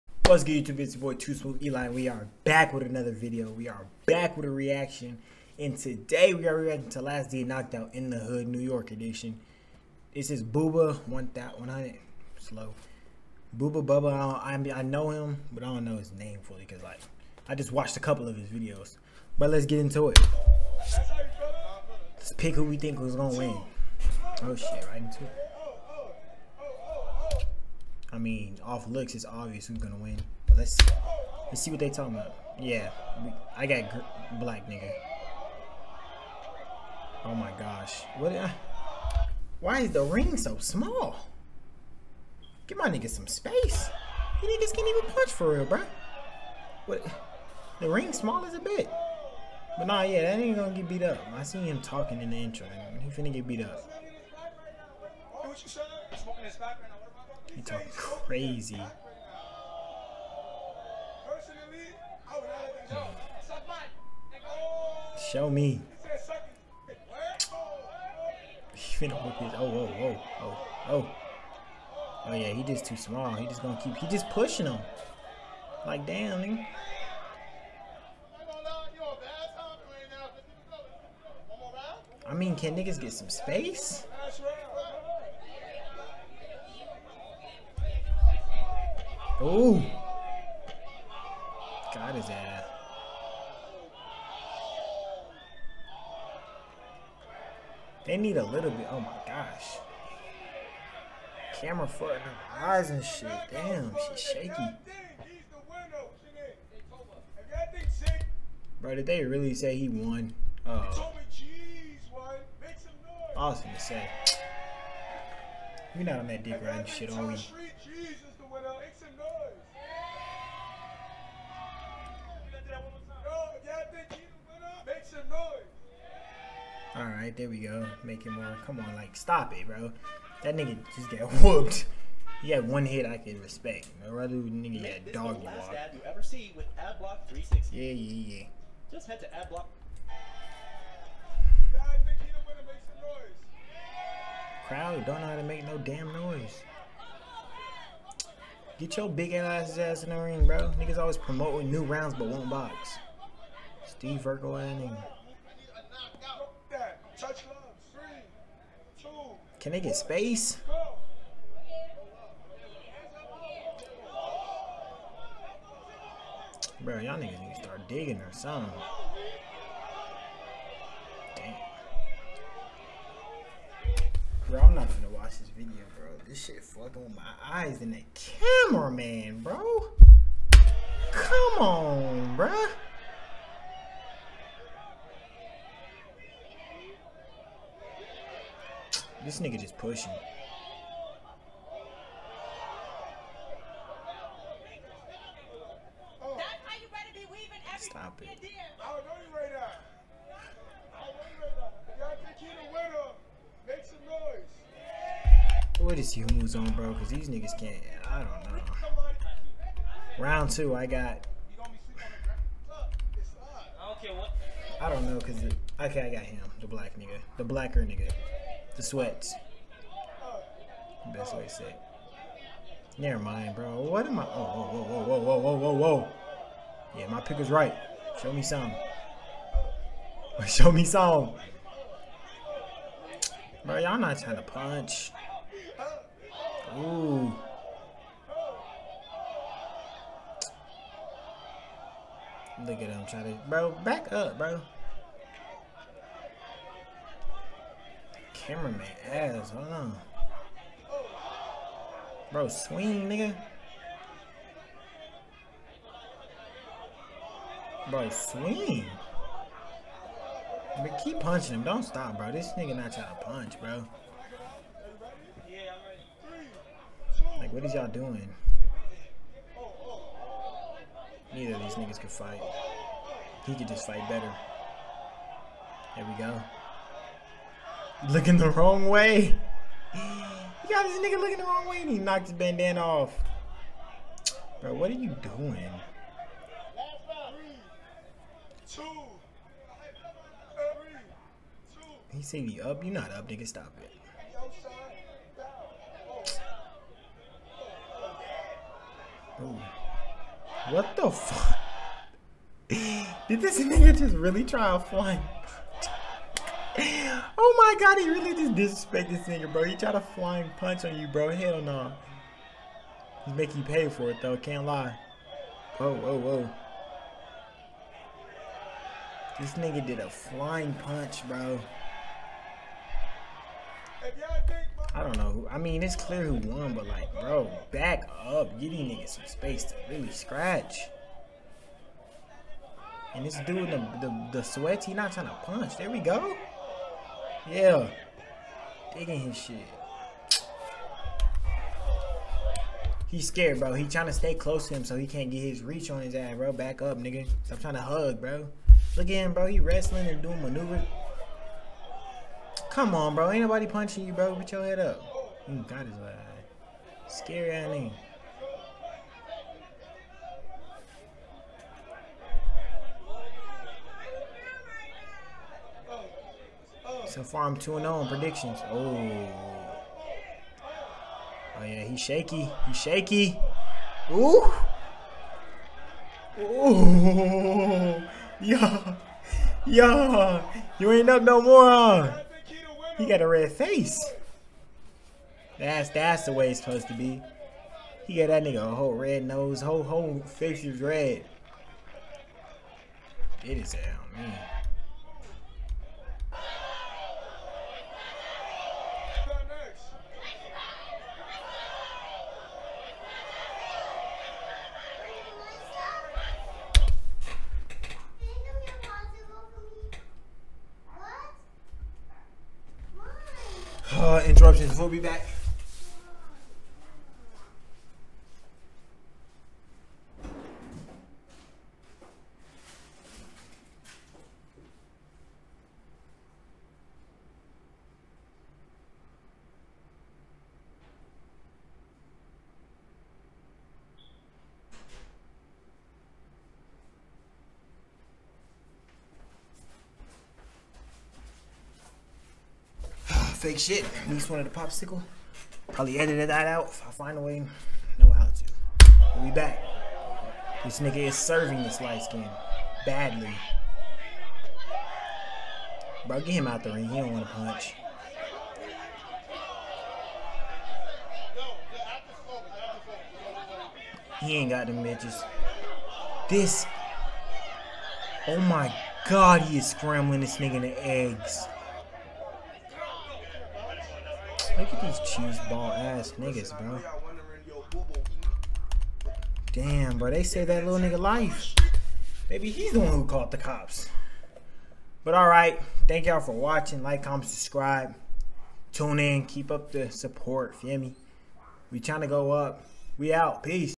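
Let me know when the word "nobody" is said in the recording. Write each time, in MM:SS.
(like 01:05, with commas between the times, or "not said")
05:53.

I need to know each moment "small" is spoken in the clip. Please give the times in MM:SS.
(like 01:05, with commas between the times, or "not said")
00:40, 00:48, 01:12.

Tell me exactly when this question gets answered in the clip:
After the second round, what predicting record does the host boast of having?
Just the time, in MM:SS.
06:07.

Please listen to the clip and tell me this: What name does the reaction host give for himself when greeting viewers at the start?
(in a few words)
Too Smoove Eli.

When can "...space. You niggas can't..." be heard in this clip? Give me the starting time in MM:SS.
00:43.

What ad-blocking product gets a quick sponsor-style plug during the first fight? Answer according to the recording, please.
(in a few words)
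AdBlock 360.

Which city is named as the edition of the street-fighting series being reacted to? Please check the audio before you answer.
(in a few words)
New York.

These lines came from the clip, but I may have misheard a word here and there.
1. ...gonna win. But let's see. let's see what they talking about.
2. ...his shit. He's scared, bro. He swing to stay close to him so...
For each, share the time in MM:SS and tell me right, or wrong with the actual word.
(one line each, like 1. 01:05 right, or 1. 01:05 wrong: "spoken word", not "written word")
1. 00:29 right
2. 05:39 wrong: "trying", not "swing".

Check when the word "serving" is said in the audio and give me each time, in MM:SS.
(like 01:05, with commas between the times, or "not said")
07:31.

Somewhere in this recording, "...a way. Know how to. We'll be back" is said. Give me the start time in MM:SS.
07:27.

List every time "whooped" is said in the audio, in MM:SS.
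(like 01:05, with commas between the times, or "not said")
02:11.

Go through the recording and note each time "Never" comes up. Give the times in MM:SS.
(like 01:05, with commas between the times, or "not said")
03:42.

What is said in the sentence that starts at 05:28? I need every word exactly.
Give these niggas some space to really scratch.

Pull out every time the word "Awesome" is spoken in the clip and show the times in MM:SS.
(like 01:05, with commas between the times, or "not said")
01:53.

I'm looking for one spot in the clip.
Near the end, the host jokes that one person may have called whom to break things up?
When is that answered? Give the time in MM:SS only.
08:03.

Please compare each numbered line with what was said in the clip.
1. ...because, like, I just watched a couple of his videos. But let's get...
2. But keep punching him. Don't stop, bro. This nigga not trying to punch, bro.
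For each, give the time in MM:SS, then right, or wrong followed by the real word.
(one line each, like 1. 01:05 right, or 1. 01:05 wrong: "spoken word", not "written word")
1. 00:16 right
2. 04:20 right.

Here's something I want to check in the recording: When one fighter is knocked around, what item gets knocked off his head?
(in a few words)
bandana.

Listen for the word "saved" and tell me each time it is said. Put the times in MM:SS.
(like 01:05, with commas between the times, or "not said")
08:00.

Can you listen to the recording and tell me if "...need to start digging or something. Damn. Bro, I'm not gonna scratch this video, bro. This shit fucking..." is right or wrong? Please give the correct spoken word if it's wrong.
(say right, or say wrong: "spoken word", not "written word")
wrong: "watch", not "scratch".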